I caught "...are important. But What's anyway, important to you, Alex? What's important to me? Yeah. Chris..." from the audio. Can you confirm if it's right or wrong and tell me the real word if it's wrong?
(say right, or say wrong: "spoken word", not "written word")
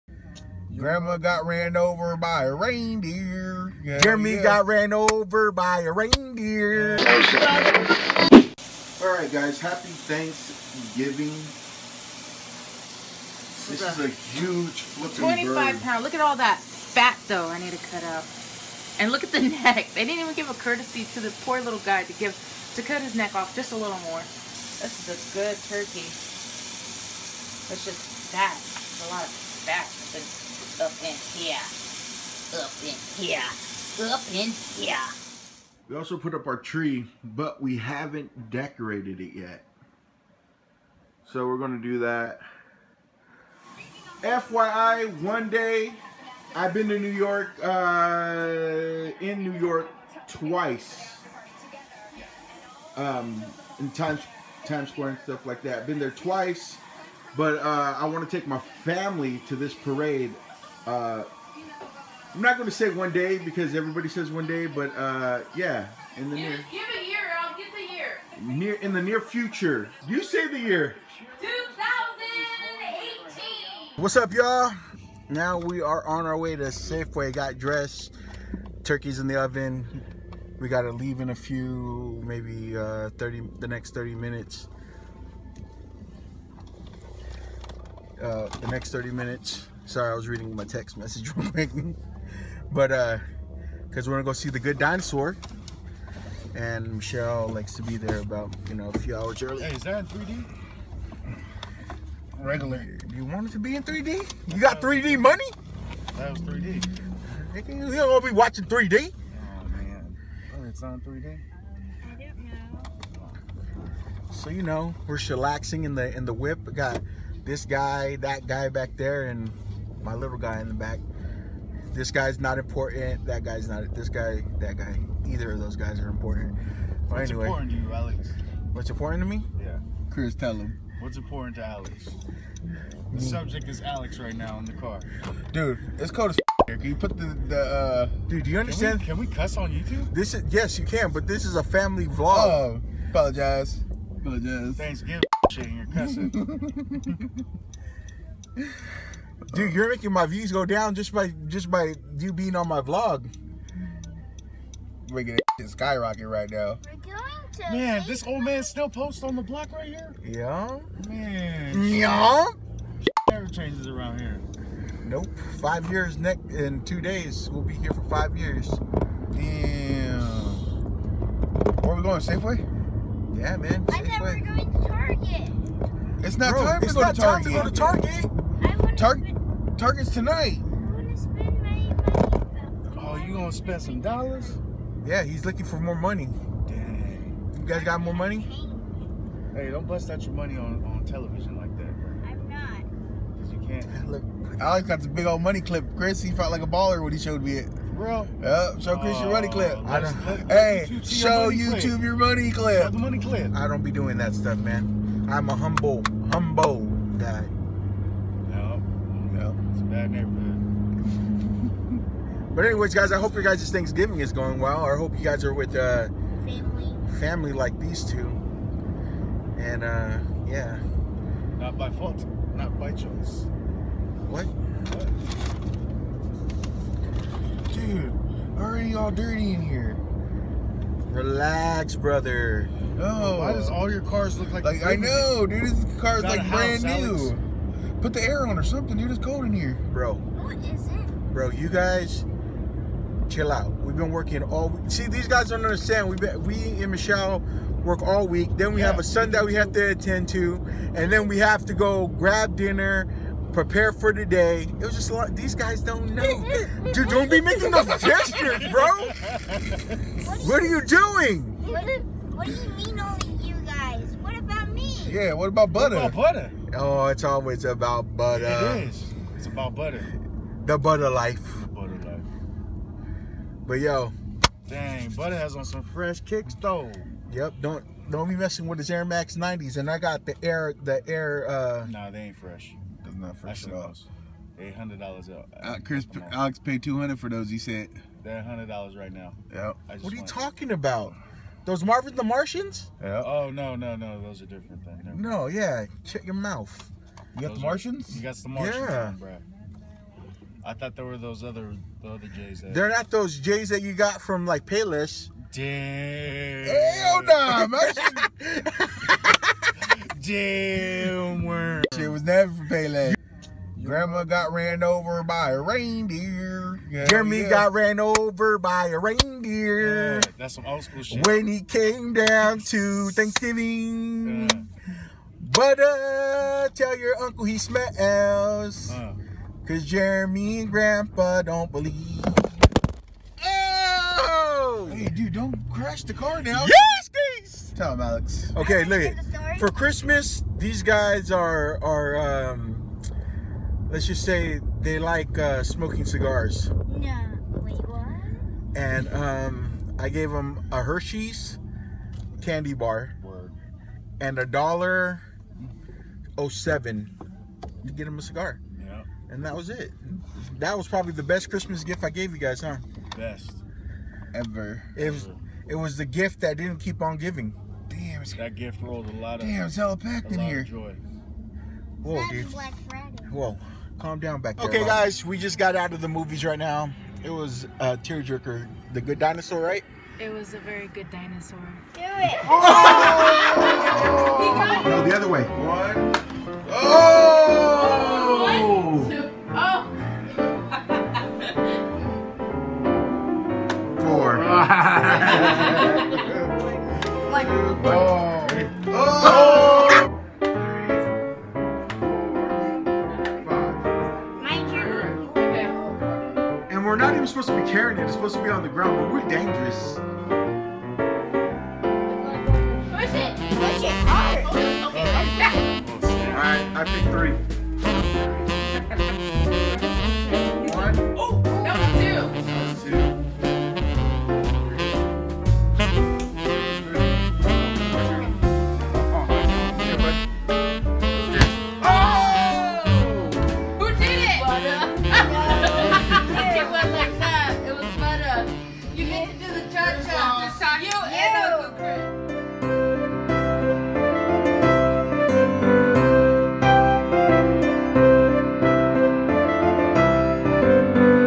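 right.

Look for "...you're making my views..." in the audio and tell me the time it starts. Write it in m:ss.
2:29.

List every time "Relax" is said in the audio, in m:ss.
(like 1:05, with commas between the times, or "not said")
3:51.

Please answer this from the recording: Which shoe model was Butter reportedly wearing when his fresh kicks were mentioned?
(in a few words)
Air Max 90s.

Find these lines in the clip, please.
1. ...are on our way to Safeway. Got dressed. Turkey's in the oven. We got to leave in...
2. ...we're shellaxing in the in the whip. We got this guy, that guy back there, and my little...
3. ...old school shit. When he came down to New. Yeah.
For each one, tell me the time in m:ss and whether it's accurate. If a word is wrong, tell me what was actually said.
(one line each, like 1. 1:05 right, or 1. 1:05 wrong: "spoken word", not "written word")
1. 1:15 right
2. 1:55 right
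3. 5:20 wrong: "Thanksgiving", not "New".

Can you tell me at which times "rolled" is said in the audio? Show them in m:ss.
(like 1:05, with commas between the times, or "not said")
6:08.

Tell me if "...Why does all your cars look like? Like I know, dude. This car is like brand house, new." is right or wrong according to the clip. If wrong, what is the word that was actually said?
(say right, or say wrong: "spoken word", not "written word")
right.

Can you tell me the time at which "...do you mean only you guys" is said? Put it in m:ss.
4:22.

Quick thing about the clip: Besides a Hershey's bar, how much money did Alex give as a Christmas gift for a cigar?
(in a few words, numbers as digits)
$1.07.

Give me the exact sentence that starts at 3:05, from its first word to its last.
Yeah, he's looking for more money.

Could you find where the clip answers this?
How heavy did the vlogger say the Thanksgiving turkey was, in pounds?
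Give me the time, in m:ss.
0:15.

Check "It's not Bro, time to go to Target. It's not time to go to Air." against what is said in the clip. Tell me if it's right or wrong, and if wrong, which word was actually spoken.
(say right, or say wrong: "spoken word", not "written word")
wrong: "Target", not "Air".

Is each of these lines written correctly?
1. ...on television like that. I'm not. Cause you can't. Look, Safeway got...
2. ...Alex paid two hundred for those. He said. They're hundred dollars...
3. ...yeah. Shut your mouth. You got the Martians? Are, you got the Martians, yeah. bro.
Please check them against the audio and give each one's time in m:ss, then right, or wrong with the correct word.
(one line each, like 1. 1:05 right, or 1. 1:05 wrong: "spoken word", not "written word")
1. 3:10 wrong: "Alex", not "Safeway"
2. 4:46 right
3. 4:55 right.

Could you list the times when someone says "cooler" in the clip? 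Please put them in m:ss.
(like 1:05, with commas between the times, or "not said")
not said.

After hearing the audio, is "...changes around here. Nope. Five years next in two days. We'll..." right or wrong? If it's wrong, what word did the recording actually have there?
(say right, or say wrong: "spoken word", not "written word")
right.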